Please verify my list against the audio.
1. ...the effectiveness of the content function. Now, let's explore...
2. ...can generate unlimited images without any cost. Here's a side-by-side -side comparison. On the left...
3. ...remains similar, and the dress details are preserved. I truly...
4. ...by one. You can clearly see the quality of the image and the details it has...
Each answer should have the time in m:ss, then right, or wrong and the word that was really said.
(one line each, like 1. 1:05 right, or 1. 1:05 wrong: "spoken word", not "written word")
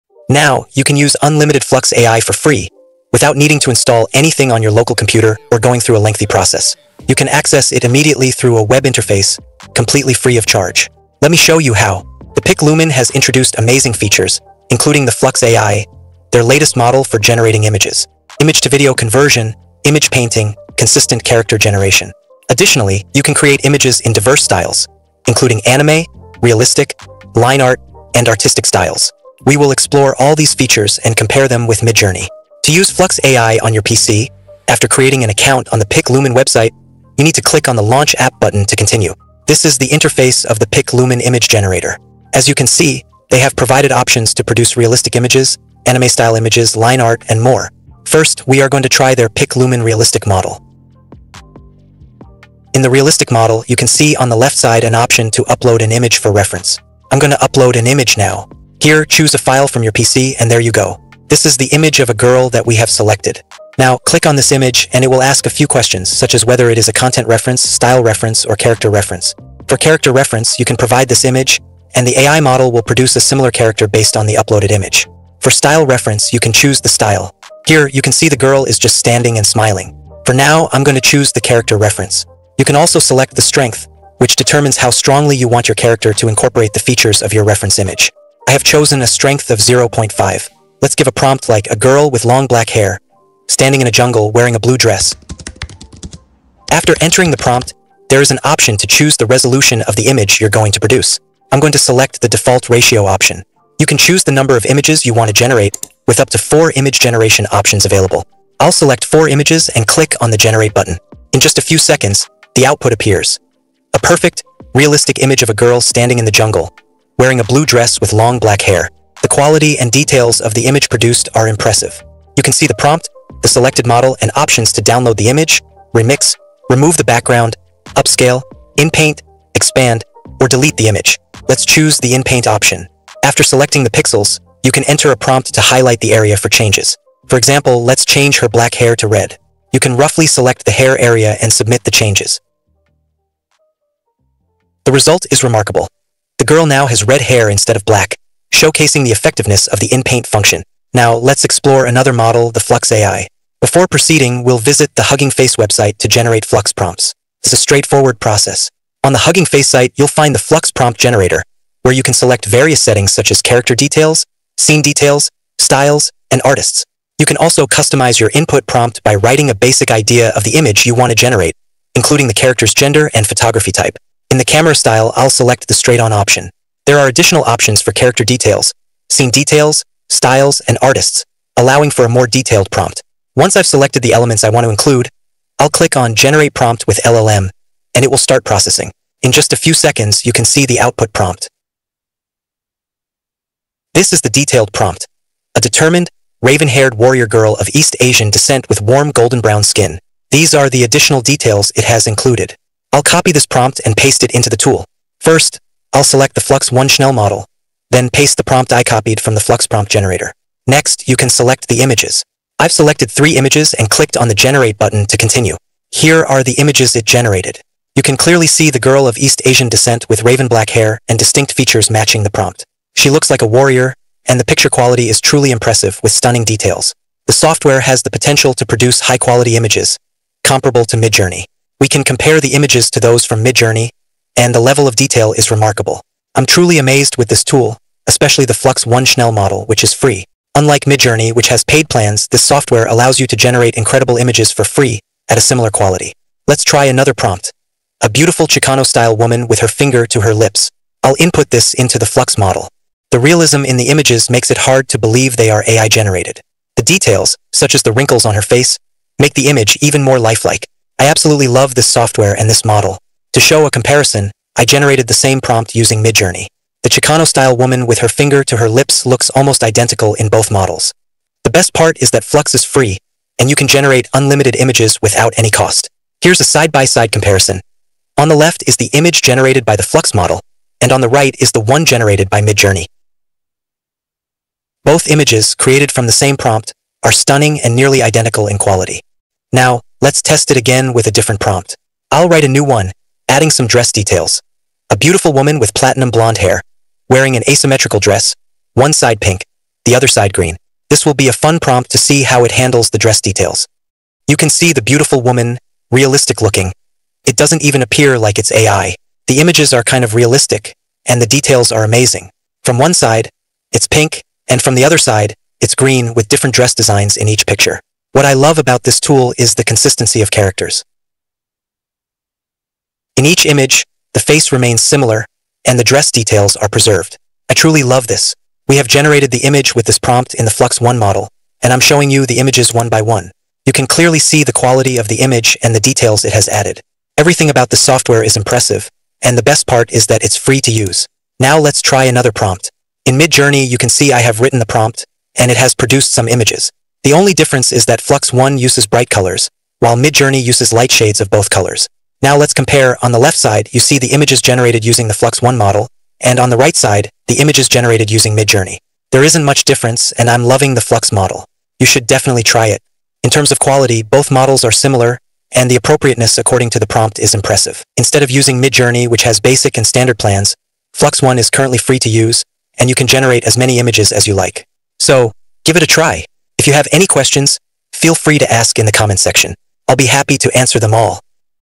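1. 2:29 wrong: "inpaint", not "content"
2. 4:33 right
3. 5:24 right
4. 5:32 right.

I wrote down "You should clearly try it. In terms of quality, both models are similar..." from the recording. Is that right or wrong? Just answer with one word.
wrong.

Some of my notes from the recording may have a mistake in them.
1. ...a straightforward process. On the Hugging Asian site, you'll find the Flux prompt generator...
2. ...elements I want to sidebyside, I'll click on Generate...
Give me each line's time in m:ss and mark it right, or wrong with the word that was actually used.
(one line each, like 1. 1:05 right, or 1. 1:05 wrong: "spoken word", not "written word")
1. 2:37 wrong: "Face", not "Asian"
2. 3:04 wrong: "include", not "sidebyside".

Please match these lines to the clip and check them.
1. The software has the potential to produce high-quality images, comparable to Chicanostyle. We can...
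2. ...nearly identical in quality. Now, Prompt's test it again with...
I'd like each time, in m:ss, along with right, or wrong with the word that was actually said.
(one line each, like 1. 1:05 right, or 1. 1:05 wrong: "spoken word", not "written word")
1. 3:47 wrong: "Midjourney", not "Chicanostyle"
2. 4:47 wrong: "Let", not "Prompt".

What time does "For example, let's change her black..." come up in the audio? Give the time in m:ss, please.
2:17.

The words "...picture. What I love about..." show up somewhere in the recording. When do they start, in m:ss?
5:17.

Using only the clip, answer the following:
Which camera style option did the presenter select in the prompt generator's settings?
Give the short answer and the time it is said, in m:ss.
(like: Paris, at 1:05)
Straight-on, at 2:55.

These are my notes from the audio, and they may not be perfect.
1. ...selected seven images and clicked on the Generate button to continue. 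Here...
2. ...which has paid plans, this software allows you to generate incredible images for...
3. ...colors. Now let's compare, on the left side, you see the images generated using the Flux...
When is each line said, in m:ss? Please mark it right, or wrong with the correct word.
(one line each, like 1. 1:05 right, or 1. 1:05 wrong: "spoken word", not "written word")
1. 3:32 wrong: "three", not "seven"
2. 4:01 right
3. 5:51 right.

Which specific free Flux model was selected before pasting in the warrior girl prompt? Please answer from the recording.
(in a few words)
Flux 1 Schnell.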